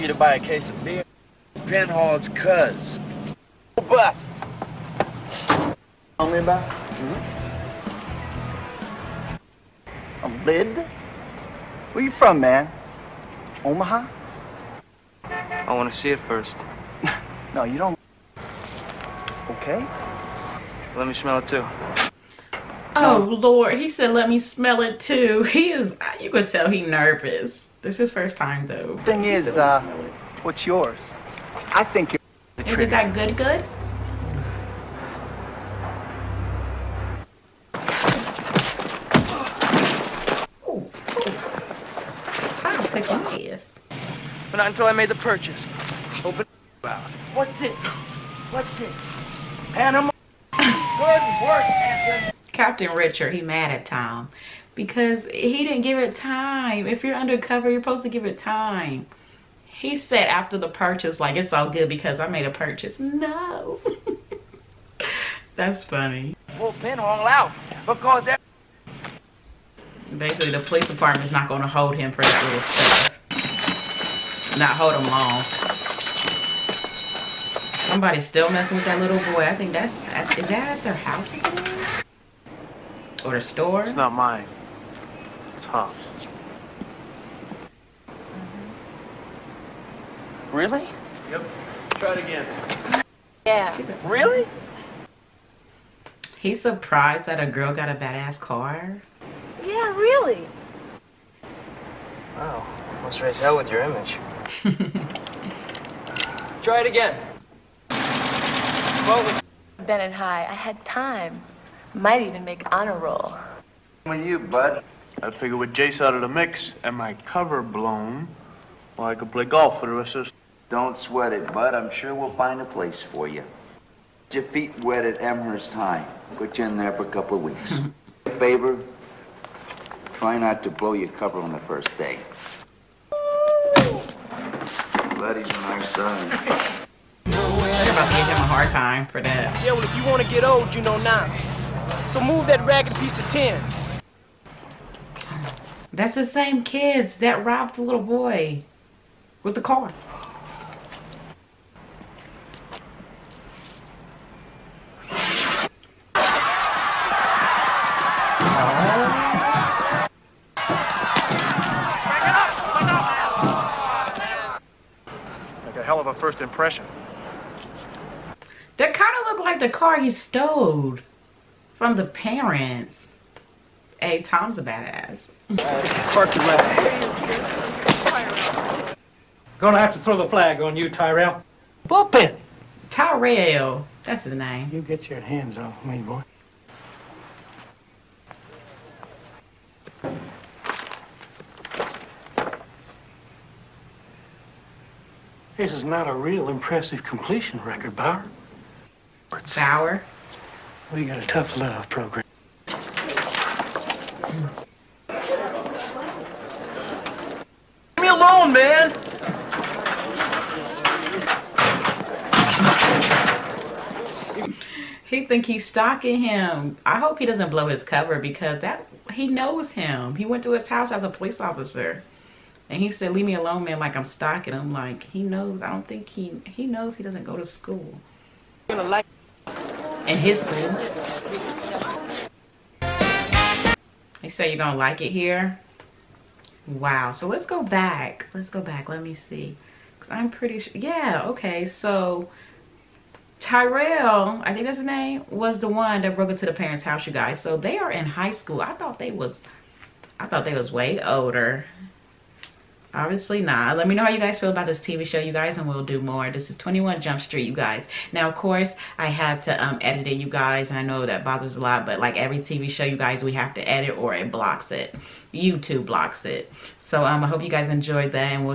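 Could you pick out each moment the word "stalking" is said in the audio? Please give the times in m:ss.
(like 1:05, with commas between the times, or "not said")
3:35, 3:44.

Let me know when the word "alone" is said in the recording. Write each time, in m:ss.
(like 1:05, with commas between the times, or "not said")
3:28, 3:43.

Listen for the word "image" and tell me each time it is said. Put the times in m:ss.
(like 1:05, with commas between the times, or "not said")
1:43.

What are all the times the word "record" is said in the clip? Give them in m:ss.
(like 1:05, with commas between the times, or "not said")
3:17.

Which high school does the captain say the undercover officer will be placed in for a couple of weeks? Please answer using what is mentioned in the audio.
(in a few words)
Amherst High.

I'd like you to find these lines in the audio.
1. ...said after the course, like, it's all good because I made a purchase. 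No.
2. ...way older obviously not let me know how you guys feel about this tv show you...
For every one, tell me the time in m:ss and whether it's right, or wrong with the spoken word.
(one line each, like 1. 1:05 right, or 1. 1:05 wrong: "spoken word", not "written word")
1. 0:59 wrong: "purchase", not "course"
2. 4:10 right.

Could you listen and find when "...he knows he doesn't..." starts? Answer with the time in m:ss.
3:46.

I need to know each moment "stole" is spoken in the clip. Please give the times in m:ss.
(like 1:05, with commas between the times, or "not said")
2:50.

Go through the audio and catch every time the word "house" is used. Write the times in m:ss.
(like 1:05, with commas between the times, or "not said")
1:20, 3:40, 4:06.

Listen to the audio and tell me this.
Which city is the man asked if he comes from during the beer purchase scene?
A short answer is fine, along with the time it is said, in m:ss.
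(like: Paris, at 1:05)
Omaha, at 0:13.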